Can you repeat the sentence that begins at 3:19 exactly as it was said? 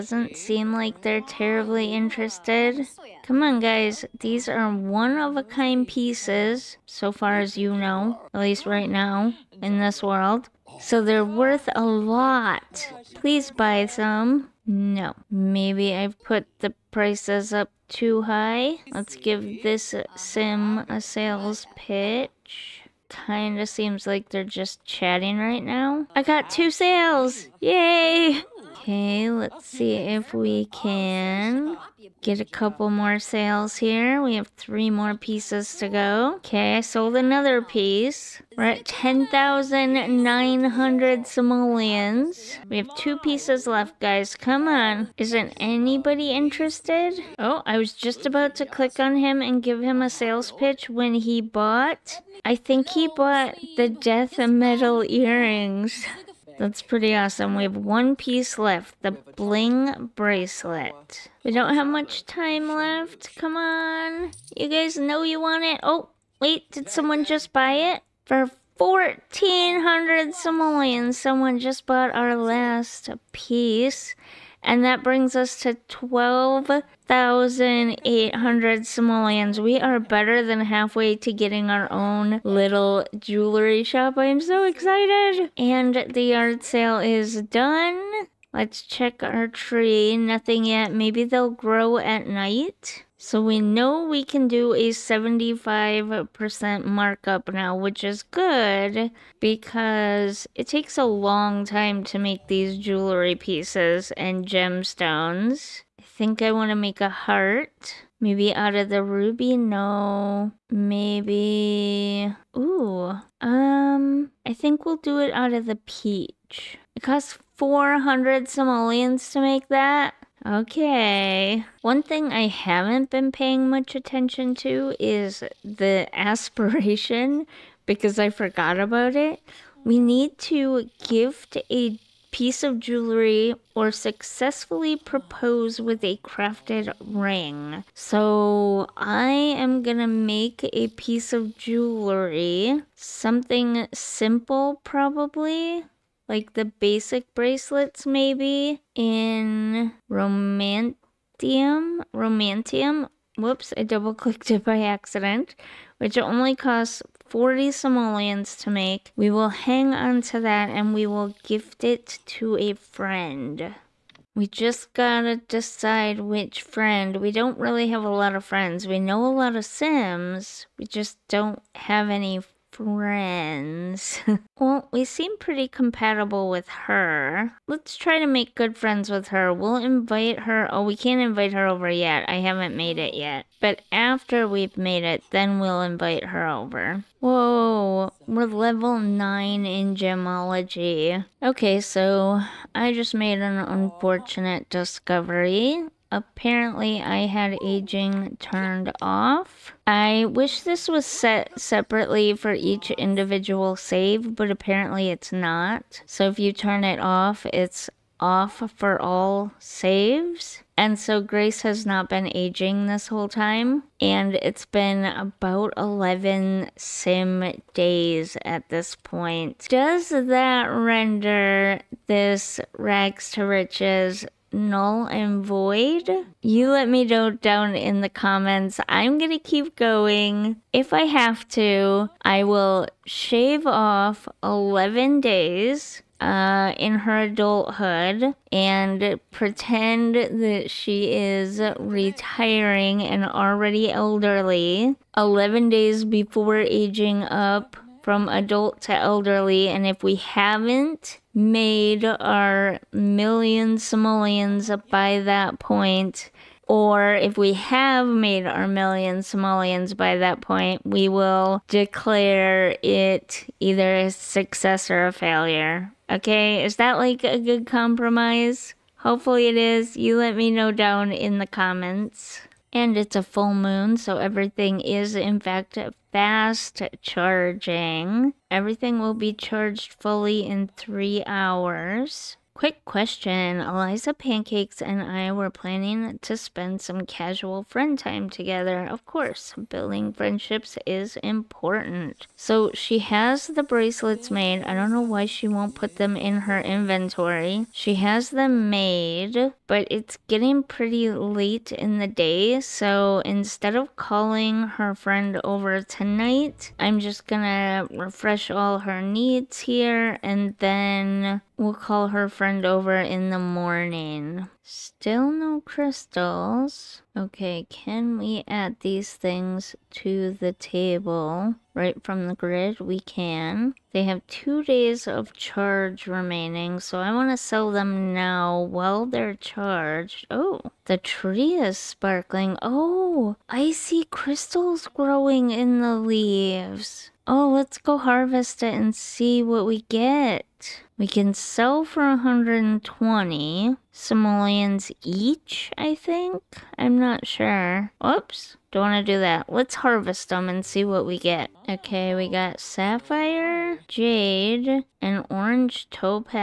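I wish this was set separately for each individual save, but apparently it's not.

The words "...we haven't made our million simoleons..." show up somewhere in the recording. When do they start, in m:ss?
4:10.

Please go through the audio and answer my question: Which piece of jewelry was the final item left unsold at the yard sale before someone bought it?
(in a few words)
bling bracelet.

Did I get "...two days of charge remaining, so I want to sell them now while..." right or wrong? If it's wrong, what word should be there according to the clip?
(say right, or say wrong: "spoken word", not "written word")
right.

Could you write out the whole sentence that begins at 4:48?
Of course, building friendships is important.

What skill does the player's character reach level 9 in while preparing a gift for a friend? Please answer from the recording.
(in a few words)
gemology.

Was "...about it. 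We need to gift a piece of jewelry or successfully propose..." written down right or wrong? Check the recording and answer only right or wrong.
right.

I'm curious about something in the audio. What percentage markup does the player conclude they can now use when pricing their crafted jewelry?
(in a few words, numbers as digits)
75%.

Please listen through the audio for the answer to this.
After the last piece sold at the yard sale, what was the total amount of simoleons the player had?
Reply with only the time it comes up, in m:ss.
1:15.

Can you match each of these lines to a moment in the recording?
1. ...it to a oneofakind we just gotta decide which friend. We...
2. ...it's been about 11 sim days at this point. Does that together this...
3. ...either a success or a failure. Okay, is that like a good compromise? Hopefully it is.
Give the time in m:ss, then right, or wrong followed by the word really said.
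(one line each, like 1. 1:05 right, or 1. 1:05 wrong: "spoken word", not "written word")
1. 2:41 wrong: "friend", not "oneofakind"
2. 3:34 wrong: "render", not "together"
3. 4:23 right.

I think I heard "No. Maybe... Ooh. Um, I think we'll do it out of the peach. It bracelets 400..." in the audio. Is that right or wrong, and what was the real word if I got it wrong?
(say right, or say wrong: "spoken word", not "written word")
wrong: "costs", not "bracelets".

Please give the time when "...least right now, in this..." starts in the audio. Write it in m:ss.
0:08.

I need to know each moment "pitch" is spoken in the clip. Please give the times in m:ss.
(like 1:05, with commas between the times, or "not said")
0:21, 0:50.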